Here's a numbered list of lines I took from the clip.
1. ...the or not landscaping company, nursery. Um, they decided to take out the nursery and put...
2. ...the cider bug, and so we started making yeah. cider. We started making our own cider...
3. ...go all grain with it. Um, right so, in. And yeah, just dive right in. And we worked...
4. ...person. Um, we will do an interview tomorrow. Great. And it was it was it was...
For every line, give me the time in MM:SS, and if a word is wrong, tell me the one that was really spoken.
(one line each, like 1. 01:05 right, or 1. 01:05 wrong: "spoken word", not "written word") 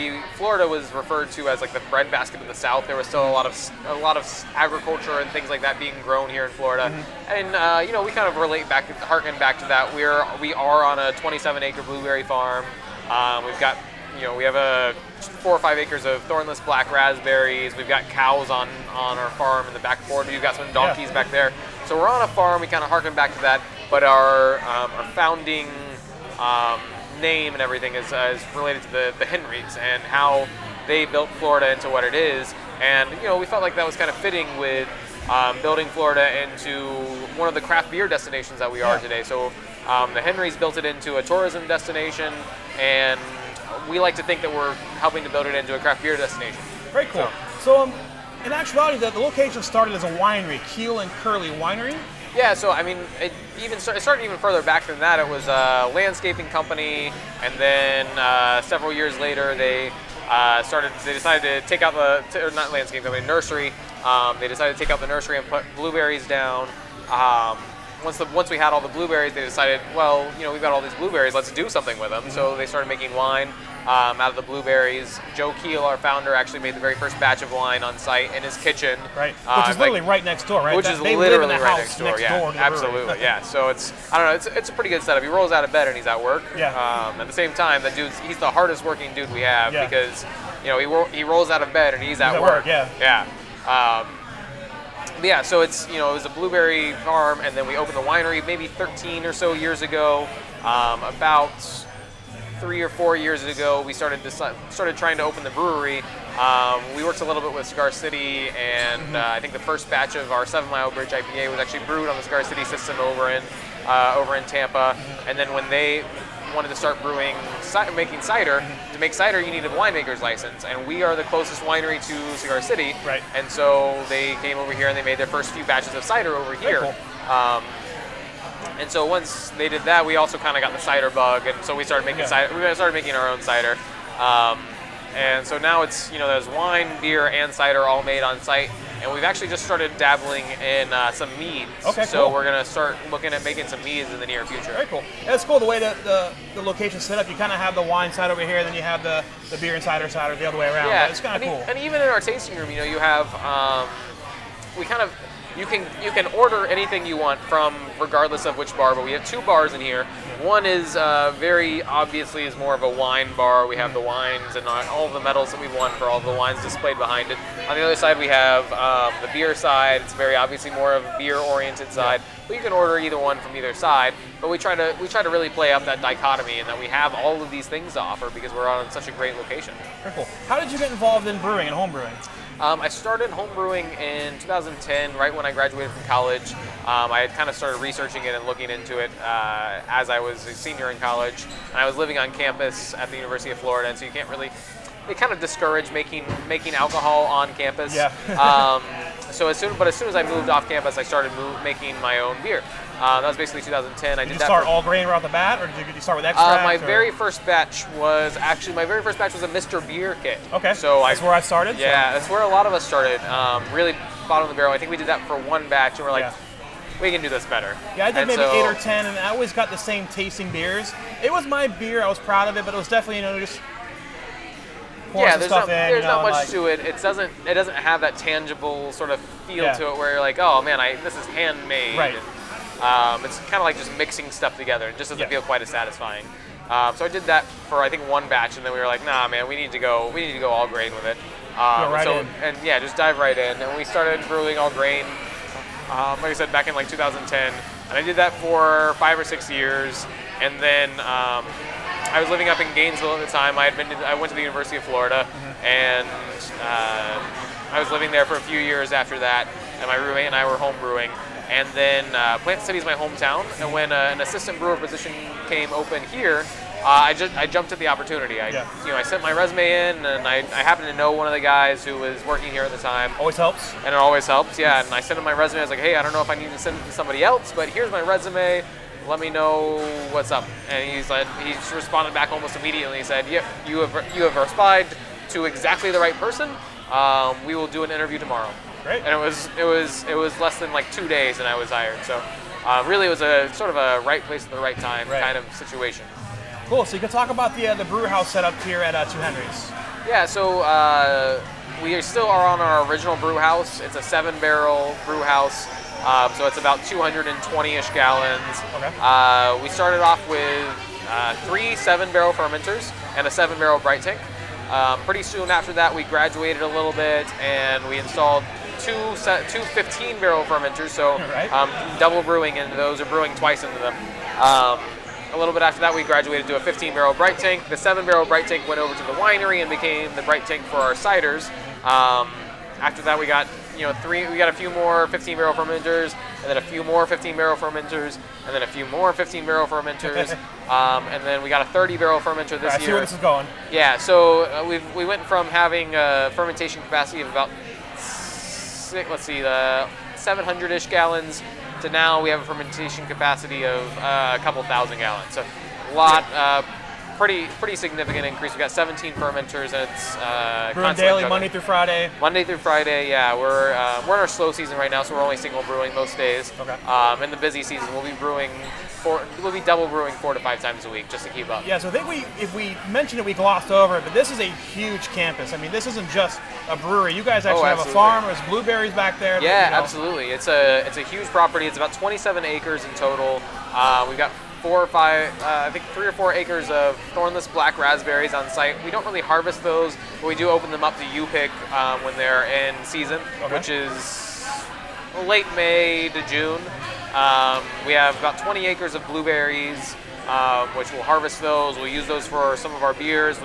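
1. 01:01 right
2. 02:10 right
3. 04:00 wrong: "started", not "worked"
4. 04:46 right.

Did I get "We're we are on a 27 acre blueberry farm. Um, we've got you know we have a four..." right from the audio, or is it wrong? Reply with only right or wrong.
right.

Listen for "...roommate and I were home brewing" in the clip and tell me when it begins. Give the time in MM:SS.
04:19.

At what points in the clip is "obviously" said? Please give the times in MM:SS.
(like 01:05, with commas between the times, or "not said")
02:41, 02:50.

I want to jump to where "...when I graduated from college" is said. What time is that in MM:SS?
03:05.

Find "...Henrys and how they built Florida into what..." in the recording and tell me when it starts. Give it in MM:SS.
00:29.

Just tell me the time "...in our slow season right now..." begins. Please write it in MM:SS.
06:04.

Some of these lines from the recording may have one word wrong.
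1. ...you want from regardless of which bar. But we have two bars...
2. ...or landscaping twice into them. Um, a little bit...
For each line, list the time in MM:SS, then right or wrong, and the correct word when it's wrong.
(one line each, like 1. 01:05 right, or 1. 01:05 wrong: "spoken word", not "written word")
1. 02:37 right
2. 05:23 wrong: "brewing", not "landscaping".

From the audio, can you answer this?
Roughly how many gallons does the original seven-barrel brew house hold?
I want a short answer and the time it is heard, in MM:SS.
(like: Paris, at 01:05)
220, at 05:06.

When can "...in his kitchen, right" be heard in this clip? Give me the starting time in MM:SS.
01:18.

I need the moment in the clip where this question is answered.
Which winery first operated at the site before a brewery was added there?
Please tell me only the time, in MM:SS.
00:50.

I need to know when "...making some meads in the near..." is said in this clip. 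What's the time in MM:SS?
02:23.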